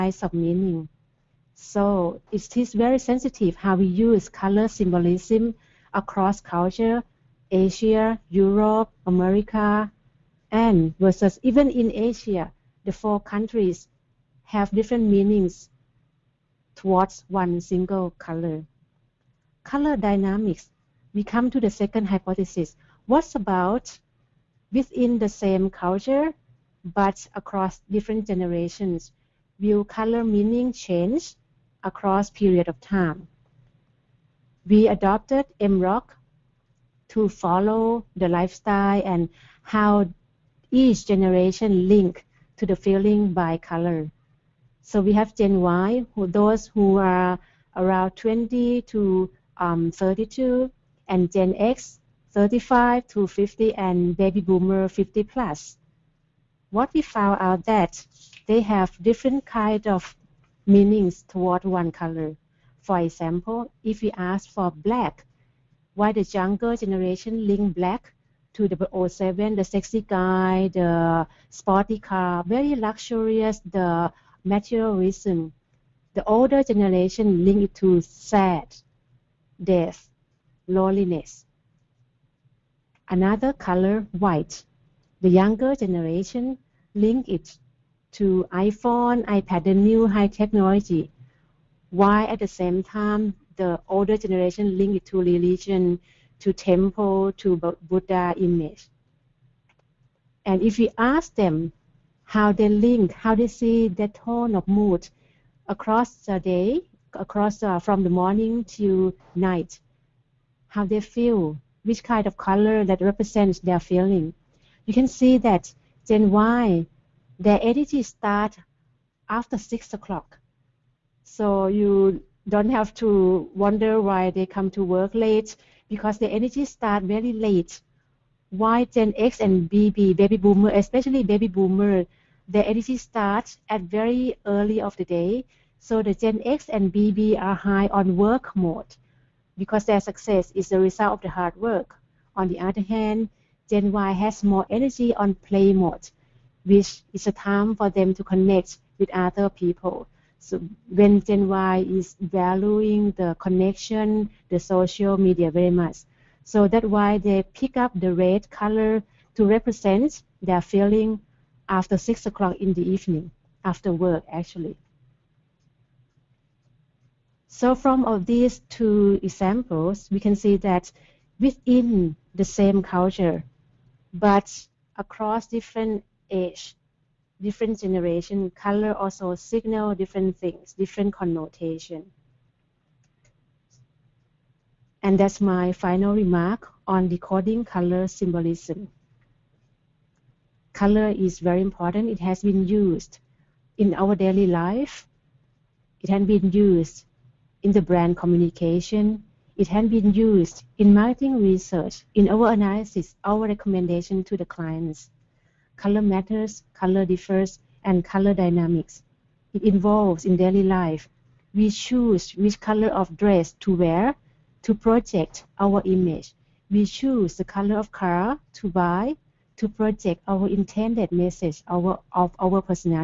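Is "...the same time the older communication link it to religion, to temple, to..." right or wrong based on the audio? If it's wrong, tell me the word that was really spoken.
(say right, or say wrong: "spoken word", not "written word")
wrong: "generation", not "communication".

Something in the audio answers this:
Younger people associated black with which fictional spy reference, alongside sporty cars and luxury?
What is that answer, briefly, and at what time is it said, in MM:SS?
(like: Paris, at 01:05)
007, at 01:09.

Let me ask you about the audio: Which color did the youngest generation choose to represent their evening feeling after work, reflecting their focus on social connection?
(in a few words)
Red.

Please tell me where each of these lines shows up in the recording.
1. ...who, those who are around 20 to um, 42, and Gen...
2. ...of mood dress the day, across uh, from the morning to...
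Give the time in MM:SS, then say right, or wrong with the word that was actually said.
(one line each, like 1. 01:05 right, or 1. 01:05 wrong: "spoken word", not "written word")
1. 00:46 wrong: "32", not "42"
2. 01:44 wrong: "across", not "dress".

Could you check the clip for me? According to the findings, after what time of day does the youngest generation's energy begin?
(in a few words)
6 o'clock.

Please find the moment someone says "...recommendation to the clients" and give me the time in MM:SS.
03:23.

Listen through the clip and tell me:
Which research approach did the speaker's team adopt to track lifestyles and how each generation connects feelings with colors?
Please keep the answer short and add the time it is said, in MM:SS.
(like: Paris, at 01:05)
MROC, at 00:35.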